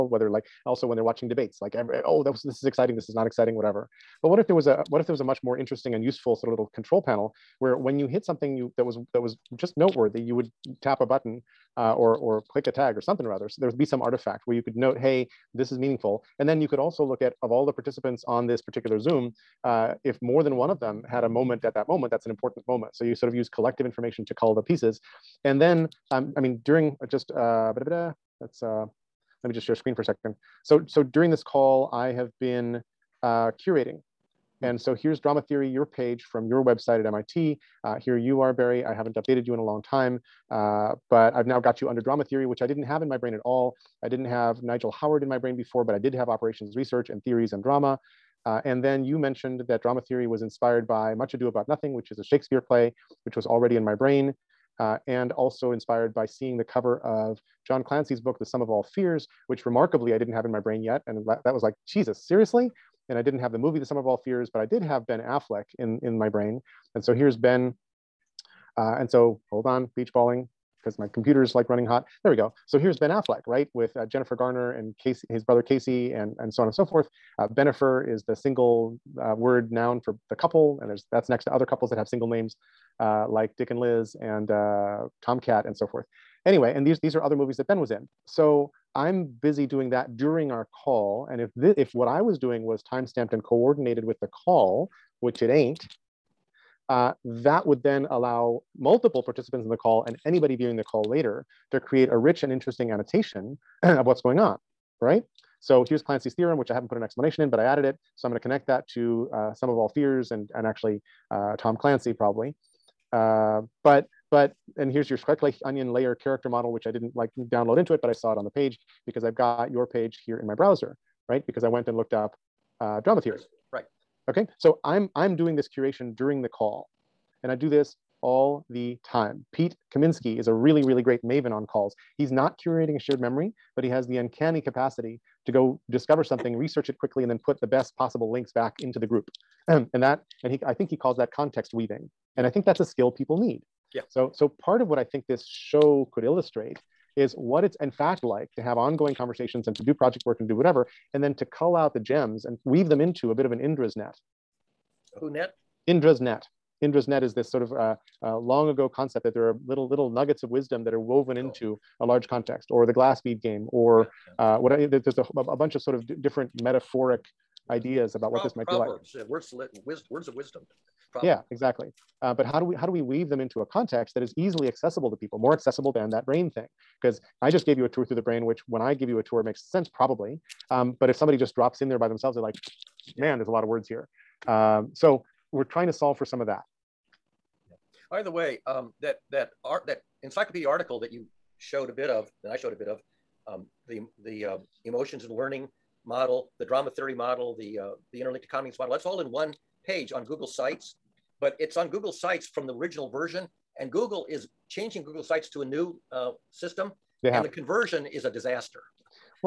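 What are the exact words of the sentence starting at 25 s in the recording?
And then, um, I mean, during just, uh, let uh, let me just share screen for a second.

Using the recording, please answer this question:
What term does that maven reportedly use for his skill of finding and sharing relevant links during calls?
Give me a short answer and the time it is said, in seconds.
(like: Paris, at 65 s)
context weaving, at 141 s.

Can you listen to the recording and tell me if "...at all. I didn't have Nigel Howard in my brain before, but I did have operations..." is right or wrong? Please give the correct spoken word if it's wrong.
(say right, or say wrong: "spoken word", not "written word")
right.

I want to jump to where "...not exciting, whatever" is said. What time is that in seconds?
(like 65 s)
3 s.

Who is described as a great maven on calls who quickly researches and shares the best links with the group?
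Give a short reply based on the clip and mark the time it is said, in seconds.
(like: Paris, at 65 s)
Pete Kaminsky, at 129 s.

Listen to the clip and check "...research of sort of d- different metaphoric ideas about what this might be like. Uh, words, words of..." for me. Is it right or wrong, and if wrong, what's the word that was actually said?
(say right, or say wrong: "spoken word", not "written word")
wrong: "bunch", not "research".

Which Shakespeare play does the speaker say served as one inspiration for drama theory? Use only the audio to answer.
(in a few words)
Much Ado About Nothing.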